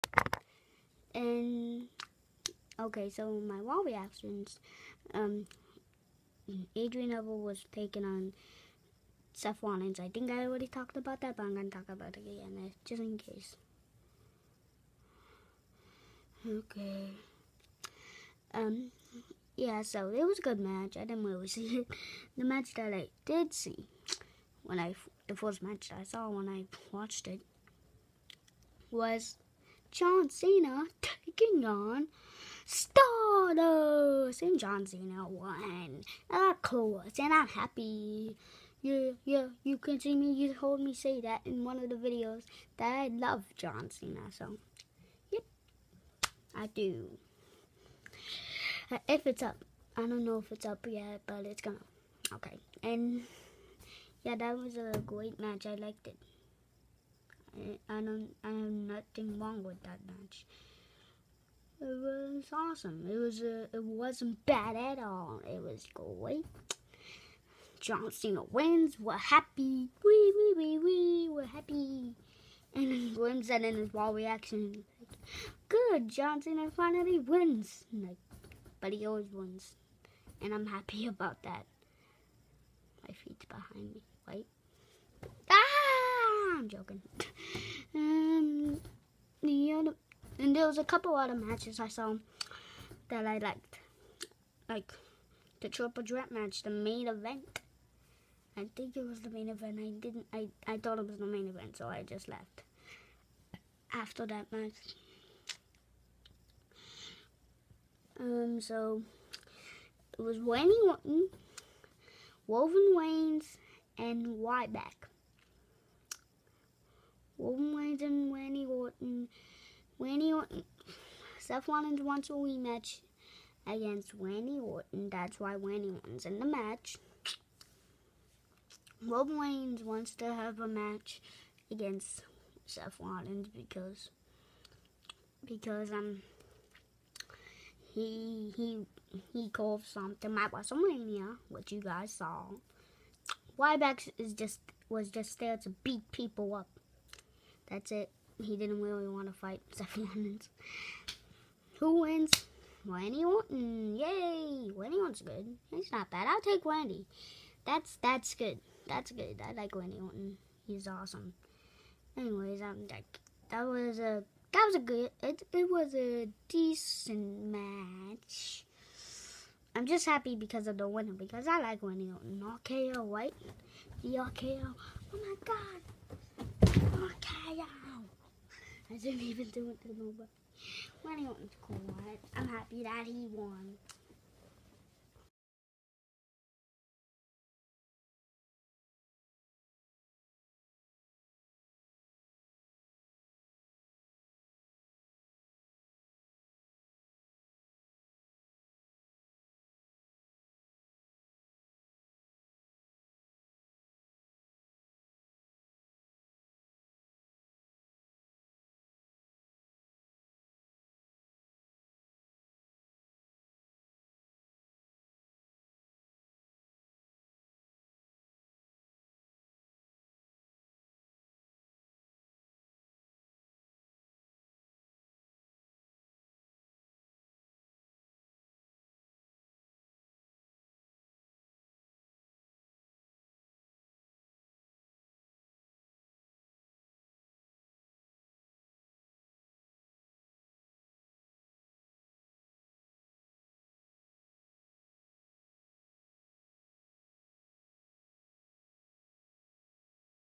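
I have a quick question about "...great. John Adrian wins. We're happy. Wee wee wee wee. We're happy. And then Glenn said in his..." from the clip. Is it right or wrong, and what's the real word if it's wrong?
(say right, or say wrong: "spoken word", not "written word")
wrong: "Cena", not "Adrian".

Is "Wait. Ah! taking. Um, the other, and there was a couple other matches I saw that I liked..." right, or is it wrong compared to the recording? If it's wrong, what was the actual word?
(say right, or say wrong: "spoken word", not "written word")
wrong: "joking", not "taking".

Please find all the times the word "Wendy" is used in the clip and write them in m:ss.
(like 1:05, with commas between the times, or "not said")
2:51.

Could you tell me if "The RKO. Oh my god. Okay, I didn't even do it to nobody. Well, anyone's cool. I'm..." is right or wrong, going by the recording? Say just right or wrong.
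right.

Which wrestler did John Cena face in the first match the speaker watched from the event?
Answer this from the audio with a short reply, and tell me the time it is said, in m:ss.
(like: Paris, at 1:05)
Stardust, at 0:32.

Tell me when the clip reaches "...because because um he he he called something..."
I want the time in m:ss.
2:13.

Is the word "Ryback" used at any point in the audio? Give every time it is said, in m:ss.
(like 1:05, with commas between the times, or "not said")
1:54, 2:23.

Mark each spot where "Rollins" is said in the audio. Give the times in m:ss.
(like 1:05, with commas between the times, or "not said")
0:09, 2:01, 2:12.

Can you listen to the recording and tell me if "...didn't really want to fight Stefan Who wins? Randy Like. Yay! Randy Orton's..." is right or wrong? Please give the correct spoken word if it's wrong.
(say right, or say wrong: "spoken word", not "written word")
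wrong: "Orton", not "Like".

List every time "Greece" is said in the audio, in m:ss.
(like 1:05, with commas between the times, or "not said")
not said.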